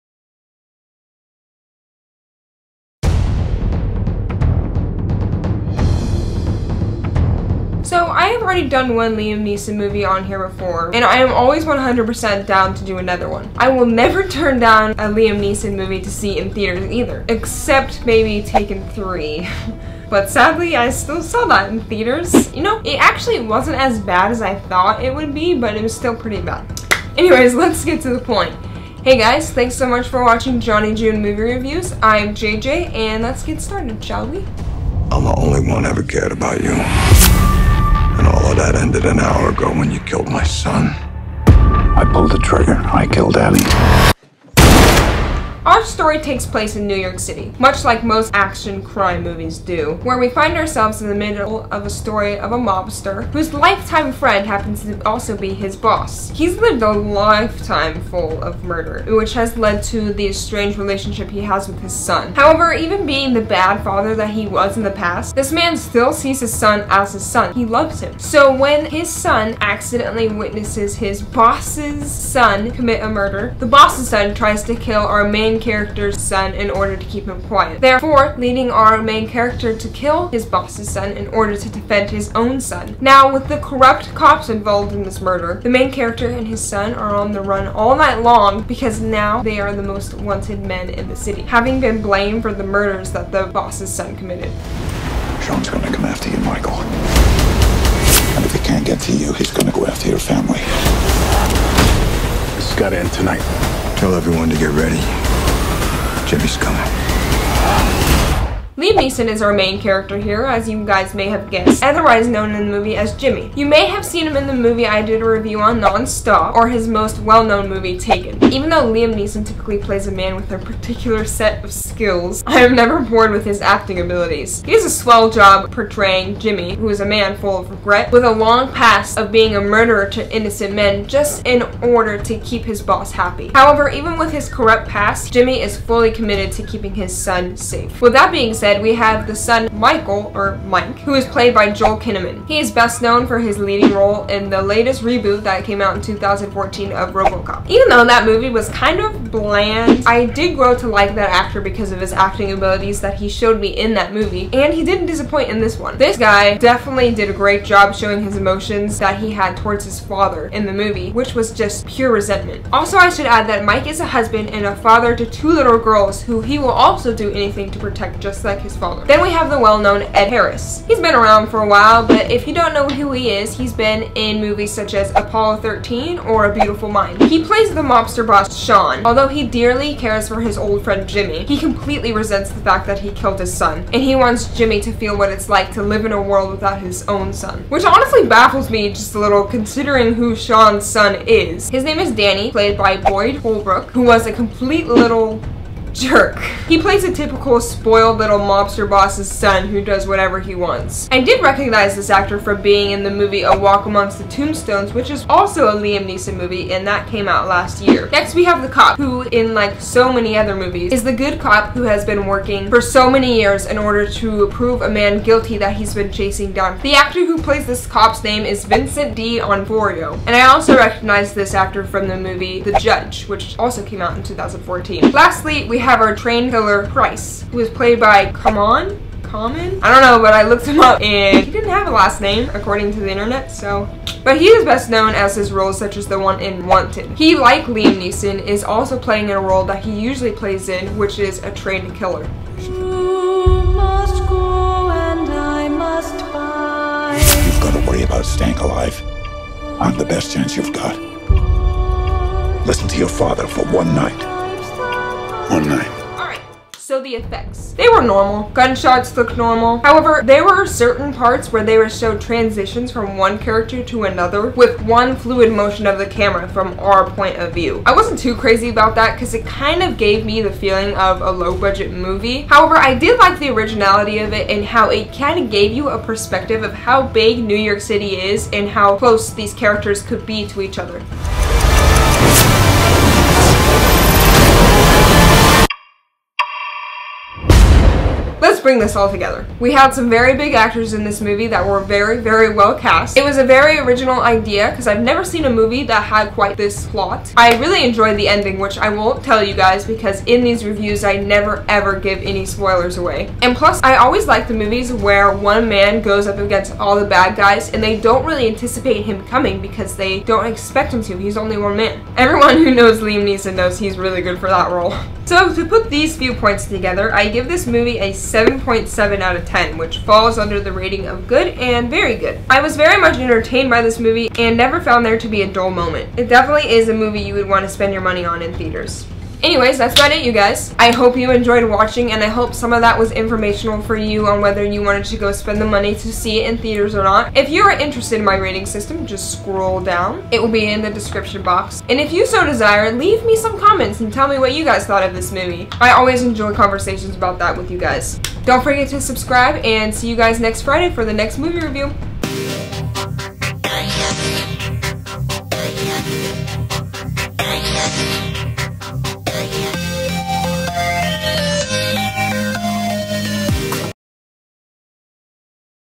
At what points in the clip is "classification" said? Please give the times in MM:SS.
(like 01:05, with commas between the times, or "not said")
not said.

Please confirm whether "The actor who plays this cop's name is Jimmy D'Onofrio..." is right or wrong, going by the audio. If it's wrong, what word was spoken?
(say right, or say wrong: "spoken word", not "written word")
wrong: "Vincent", not "Jimmy".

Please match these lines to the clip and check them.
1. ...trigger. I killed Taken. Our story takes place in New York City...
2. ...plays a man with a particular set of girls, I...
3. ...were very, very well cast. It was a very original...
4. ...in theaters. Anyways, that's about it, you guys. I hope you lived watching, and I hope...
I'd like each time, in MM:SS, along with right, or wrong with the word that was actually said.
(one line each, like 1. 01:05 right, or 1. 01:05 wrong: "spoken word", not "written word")
1. 00:42 wrong: "Abby", not "Taken"
2. 01:59 wrong: "skills", not "girls"
3. 04:51 right
4. 05:28 wrong: "enjoyed", not "lived".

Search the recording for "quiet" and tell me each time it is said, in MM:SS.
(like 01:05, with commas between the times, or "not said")
01:17.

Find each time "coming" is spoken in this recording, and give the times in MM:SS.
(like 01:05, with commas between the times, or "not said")
01:46, 05:09.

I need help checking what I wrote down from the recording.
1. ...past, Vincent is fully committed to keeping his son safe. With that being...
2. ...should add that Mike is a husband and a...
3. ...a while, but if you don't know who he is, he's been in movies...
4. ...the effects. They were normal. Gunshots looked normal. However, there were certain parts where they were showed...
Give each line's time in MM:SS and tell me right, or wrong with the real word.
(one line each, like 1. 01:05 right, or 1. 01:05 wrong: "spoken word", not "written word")
1. 02:14 wrong: "Jimmy", not "Vincent"
2. 02:43 right
3. 02:51 right
4. 04:17 right.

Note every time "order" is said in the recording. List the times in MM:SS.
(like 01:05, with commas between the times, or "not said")
01:16, 01:21, 02:11, 03:33.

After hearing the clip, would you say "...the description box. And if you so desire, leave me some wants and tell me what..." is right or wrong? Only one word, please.
wrong.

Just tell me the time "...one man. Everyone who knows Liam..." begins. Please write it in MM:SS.
05:11.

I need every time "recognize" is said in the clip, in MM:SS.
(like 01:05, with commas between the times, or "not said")
03:21, 03:40.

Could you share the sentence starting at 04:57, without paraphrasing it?
I really enjoyed the ending, which I won't tell you guys because in these reviews I never ever give any spoilers away.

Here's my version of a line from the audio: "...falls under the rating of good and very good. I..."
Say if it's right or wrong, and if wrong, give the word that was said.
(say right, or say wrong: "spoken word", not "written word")
right.